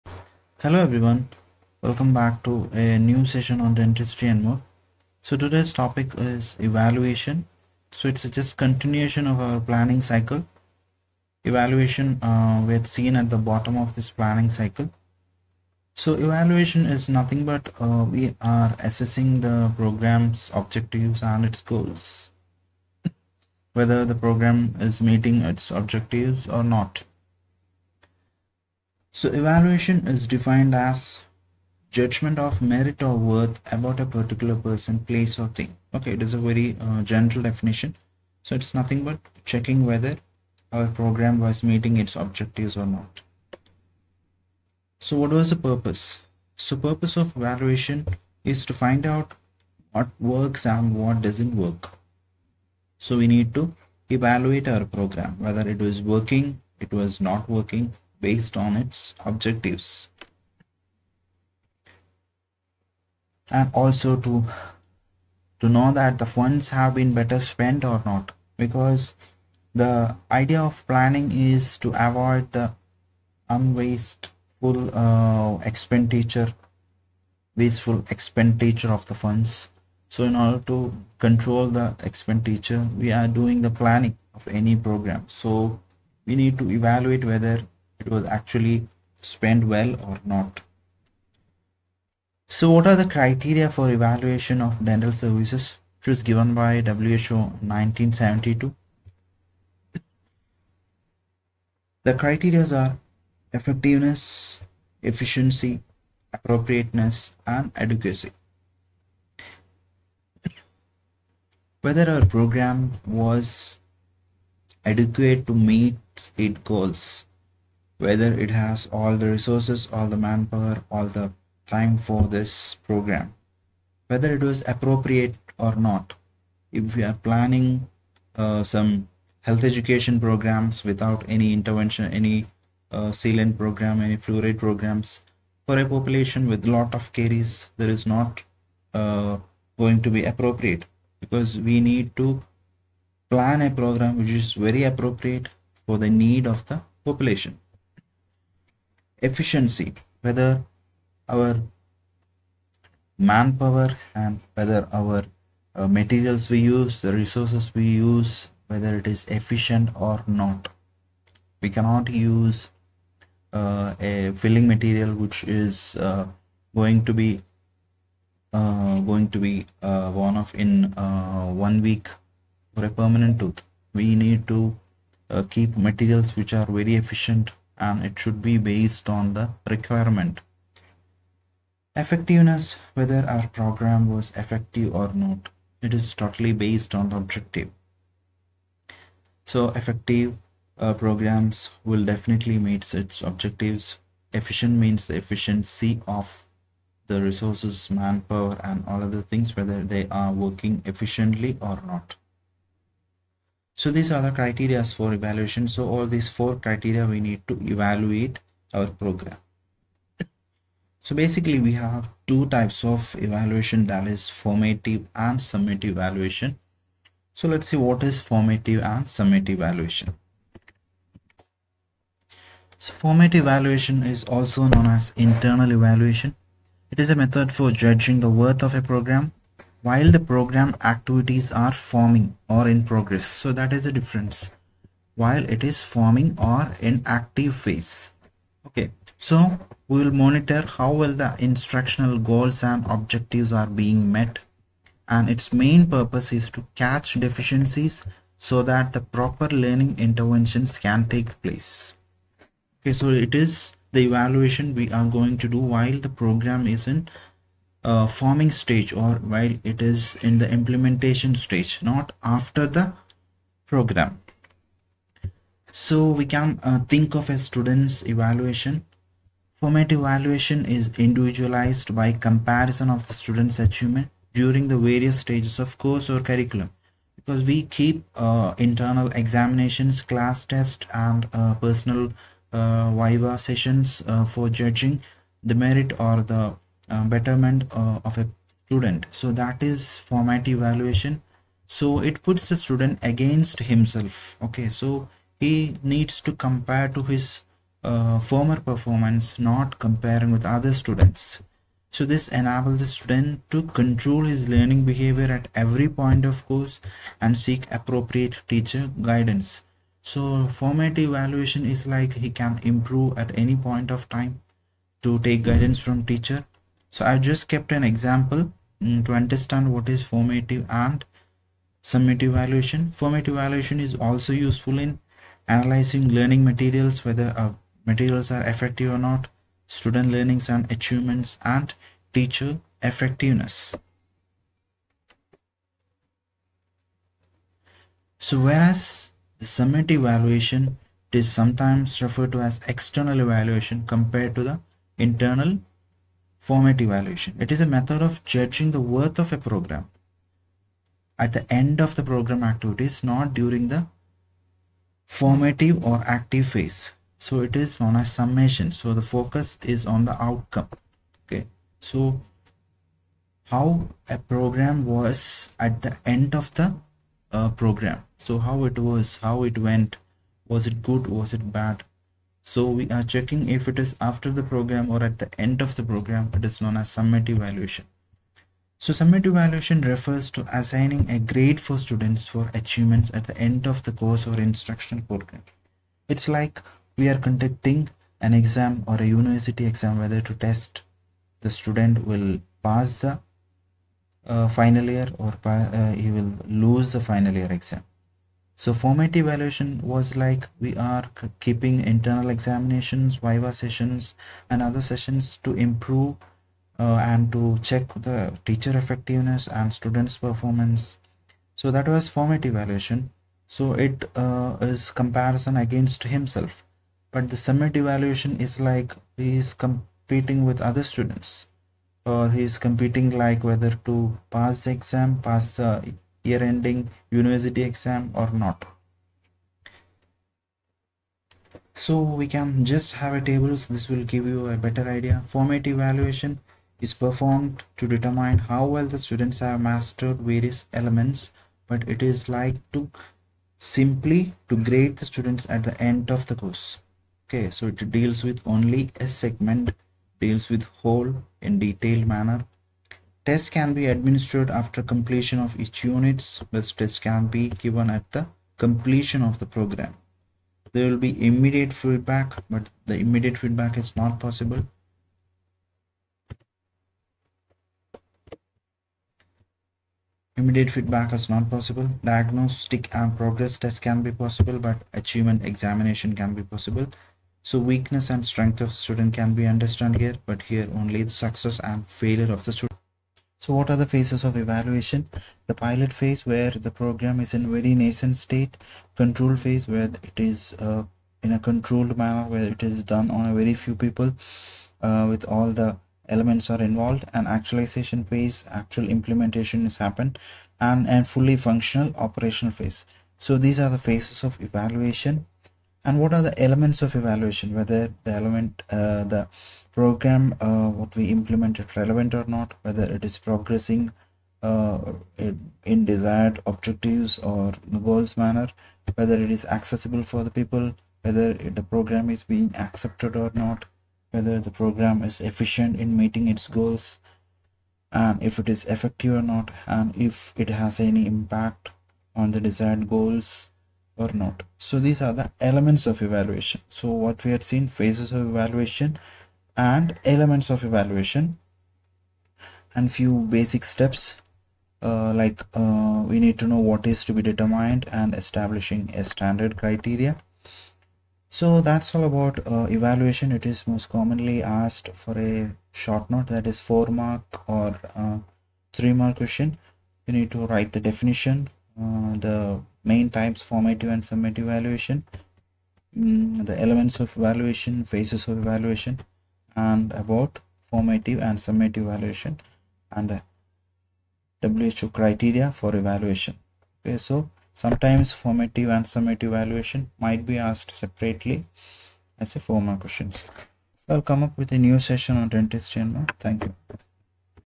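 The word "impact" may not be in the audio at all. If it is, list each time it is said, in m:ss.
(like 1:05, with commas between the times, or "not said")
8:51.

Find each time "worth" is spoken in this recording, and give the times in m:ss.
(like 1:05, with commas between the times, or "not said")
0:33, 3:48, 5:48.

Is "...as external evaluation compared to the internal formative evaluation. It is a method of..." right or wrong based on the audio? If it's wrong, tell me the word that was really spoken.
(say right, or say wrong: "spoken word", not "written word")
right.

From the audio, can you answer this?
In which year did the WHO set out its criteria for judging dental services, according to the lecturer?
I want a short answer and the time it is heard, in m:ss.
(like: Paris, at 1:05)
1972, at 1:37.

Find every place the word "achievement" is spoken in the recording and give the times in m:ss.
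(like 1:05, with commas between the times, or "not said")
4:33, 5:30, 6:22, 7:54.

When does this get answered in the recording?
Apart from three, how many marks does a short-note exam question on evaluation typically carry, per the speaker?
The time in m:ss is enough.
9:16.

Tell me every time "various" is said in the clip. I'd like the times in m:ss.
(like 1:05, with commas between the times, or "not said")
4:34, 7:20.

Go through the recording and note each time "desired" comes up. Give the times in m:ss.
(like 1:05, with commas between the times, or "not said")
8:35, 8:52.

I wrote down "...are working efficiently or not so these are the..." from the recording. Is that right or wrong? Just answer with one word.
right.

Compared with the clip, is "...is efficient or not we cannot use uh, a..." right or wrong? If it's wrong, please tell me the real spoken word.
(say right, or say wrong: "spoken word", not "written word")
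right.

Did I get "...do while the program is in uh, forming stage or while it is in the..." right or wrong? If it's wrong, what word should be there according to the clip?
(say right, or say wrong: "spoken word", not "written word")
right.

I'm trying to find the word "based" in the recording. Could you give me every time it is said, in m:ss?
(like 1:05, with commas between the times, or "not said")
0:58, 2:58, 3:06.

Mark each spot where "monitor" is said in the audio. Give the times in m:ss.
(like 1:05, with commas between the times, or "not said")
4:00.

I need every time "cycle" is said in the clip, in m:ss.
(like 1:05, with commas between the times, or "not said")
0:10, 0:14.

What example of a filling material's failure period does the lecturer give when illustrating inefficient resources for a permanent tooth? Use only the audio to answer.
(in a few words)
One week.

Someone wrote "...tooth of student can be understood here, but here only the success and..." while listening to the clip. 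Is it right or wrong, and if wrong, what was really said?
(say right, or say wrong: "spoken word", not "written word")
wrong: "strength", not "tooth".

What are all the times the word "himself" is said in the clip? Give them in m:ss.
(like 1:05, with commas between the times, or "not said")
4:53, 6:56.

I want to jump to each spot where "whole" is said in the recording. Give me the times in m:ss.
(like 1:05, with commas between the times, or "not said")
7:30.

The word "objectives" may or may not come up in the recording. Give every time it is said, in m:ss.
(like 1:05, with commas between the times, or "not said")
0:20, 0:25, 0:42, 0:59, 3:07, 3:13, 4:02, 8:36.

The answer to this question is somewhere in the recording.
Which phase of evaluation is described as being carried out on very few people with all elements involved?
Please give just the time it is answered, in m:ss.
8:08.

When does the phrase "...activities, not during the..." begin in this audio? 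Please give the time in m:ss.
5:52.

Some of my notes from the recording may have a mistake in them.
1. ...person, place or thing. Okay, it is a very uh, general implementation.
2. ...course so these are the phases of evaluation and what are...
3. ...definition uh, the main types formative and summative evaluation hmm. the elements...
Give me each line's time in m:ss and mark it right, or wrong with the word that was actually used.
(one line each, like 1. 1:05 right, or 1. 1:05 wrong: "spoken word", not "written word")
1. 0:34 wrong: "definition", not "implementation"
2. 8:22 wrong: "phase", not "course"
3. 9:20 right.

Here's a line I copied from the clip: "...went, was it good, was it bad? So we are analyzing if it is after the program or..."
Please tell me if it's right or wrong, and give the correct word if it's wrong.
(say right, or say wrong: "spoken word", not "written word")
wrong: "checking", not "analyzing".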